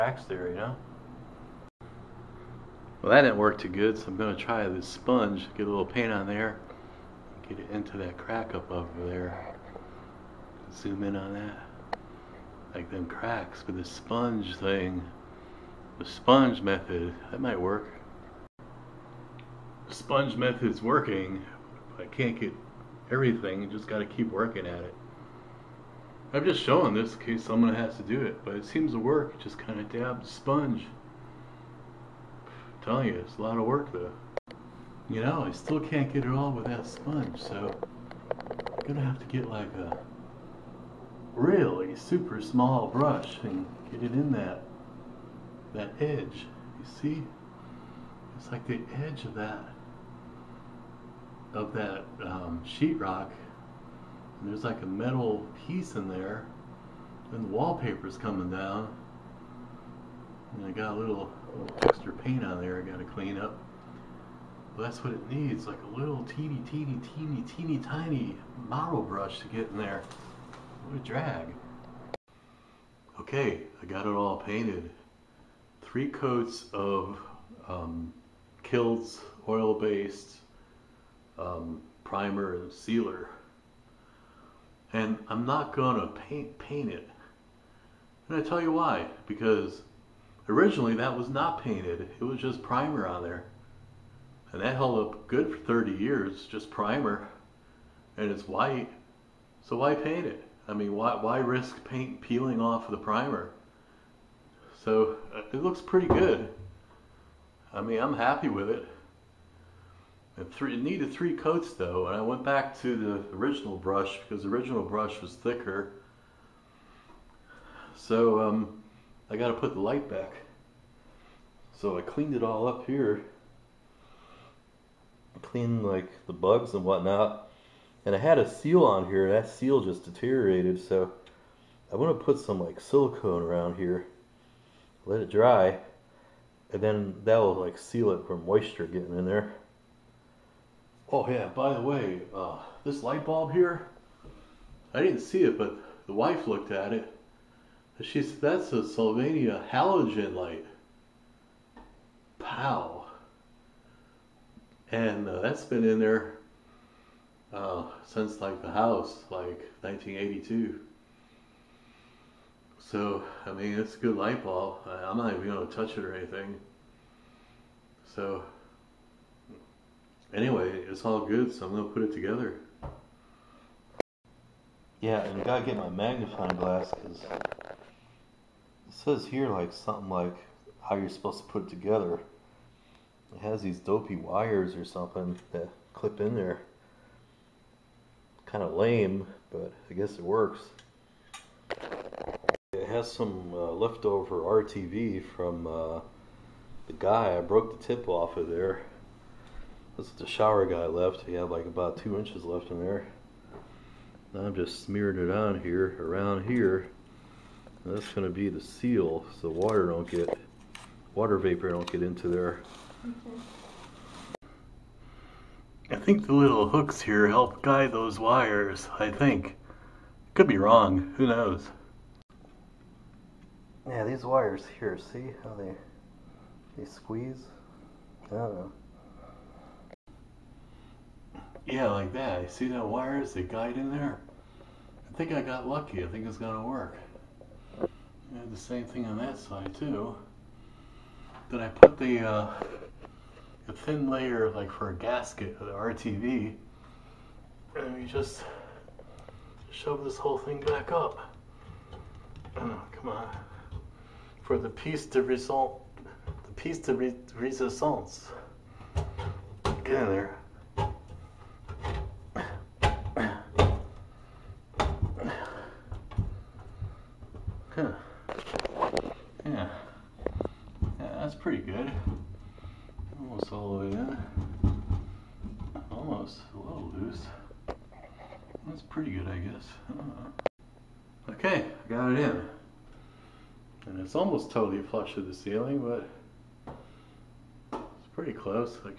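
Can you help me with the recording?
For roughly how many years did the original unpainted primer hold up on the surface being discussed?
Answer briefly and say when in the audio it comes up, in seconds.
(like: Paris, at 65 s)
30, at 95 s.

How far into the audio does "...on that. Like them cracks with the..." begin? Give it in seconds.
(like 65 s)
11 s.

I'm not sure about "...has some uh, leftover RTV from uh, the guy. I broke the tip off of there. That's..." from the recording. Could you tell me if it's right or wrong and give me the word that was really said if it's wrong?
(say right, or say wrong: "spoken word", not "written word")
right.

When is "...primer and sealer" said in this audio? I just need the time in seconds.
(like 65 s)
82 s.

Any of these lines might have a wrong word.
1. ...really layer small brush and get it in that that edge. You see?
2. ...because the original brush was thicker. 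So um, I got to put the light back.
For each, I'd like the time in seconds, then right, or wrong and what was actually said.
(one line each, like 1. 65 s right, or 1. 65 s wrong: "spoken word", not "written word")
1. 41 s wrong: "super", not "layer"
2. 114 s right.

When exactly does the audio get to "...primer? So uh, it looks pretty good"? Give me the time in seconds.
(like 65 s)
102 s.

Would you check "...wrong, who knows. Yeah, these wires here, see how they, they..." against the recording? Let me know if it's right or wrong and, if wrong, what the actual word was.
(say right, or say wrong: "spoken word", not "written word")
right.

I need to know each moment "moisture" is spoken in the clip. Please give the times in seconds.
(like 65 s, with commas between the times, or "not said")
138 s.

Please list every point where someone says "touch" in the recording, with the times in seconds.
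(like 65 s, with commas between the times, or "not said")
165 s.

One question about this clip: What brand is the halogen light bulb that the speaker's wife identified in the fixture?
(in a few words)
Sylvania.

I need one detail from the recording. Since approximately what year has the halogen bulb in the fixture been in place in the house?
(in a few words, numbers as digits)
1982.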